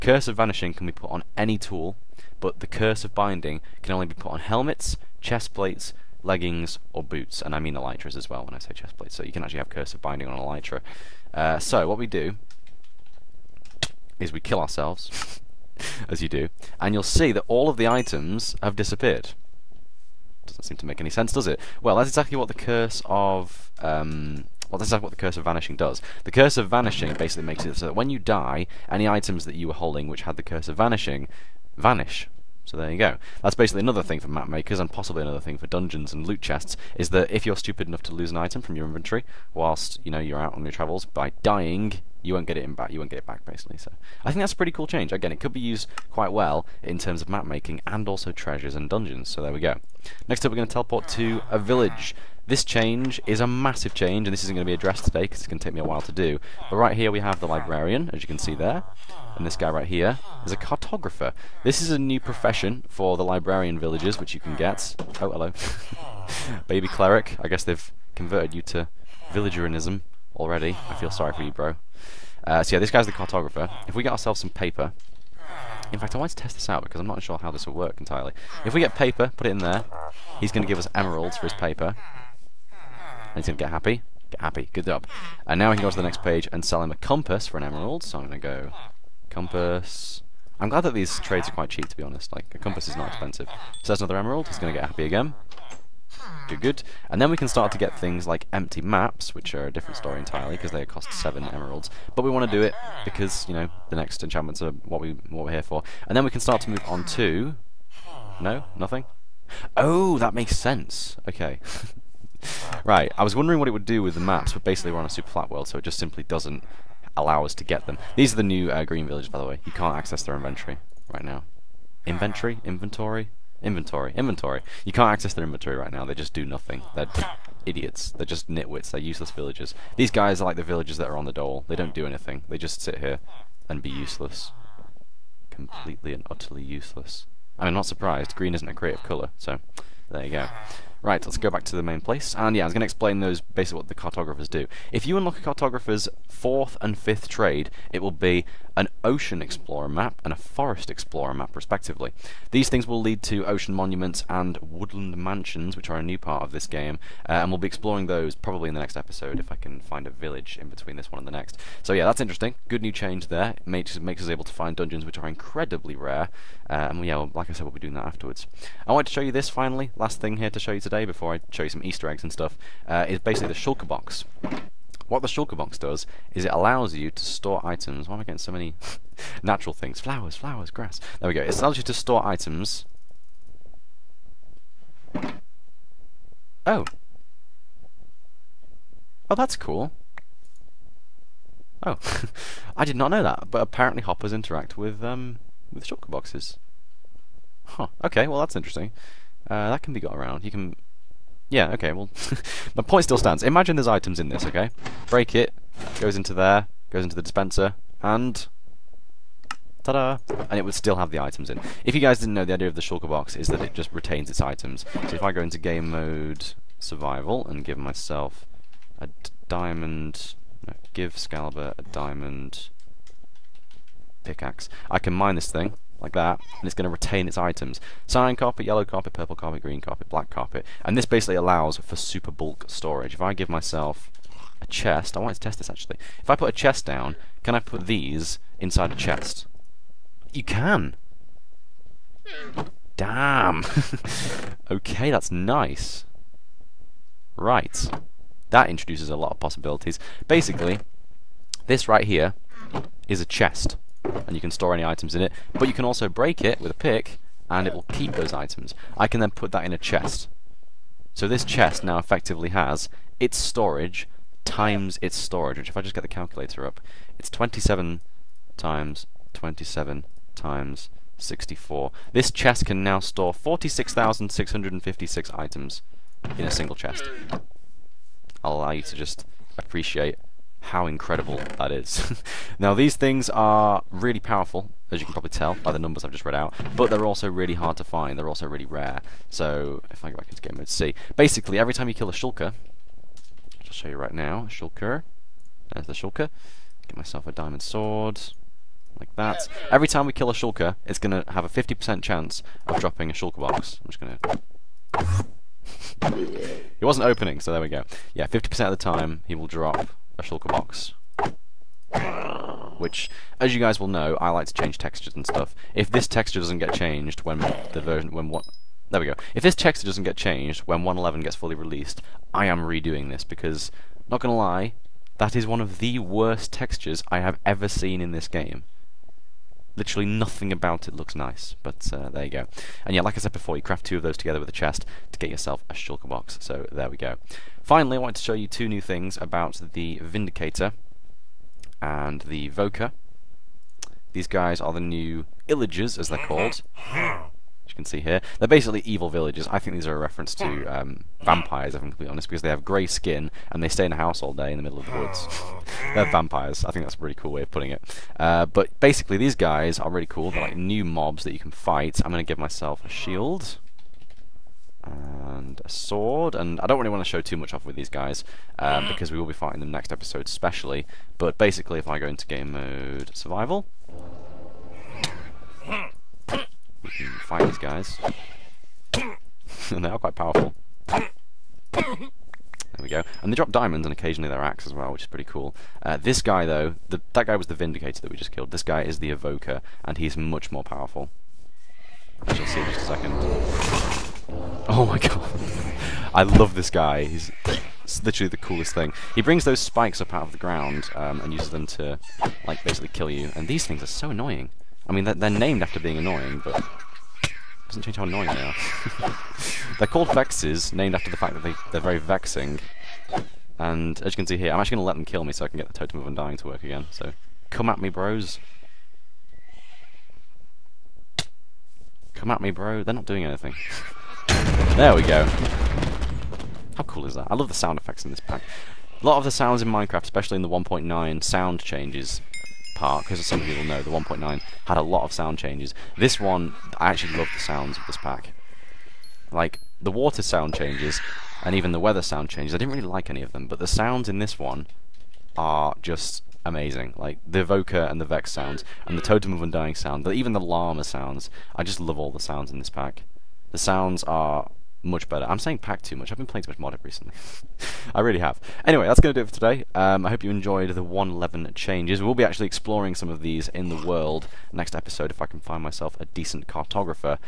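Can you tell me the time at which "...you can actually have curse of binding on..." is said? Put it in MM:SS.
00:09.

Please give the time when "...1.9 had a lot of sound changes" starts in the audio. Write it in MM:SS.
07:13.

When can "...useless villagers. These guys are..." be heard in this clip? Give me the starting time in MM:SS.
02:09.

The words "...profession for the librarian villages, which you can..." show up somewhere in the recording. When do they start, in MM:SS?
01:02.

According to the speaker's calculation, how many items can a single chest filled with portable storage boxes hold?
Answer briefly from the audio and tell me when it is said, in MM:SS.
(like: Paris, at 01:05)
46,656, at 04:33.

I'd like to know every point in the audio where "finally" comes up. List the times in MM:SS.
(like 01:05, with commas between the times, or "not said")
02:49, 05:37.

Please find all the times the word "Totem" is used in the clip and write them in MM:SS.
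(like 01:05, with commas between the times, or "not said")
06:55, 07:29.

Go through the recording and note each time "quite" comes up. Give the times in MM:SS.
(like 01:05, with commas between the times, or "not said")
00:46, 01:31, 06:19.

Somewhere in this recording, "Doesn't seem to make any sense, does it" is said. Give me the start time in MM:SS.
00:20.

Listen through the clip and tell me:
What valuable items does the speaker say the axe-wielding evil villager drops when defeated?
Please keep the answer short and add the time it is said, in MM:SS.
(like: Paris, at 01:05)
diamonds, at 06:23.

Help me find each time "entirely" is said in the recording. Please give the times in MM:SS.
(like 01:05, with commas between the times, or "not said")
01:17, 01:40.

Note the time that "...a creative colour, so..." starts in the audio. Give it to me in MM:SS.
02:18.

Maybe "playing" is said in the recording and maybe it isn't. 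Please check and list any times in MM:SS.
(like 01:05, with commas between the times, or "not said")
07:36.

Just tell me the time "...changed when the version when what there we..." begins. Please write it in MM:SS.
05:16.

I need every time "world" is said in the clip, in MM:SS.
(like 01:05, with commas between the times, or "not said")
01:55, 07:43.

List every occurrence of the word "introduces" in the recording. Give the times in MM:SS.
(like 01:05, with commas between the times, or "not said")
04:08.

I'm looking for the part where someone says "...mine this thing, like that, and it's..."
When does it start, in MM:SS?
03:45.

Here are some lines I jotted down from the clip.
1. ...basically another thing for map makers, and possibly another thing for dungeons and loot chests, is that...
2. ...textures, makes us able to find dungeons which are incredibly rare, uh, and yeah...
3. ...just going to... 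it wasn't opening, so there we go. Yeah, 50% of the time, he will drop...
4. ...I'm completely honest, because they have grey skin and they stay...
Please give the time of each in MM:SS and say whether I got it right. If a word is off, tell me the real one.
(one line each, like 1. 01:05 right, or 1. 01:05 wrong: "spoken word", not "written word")
1. 00:33 right
2. 02:43 wrong: "makes", not "textures"
3. 05:03 right
4. 05:51 right.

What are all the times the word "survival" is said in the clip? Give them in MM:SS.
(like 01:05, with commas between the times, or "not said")
03:36, 06:13.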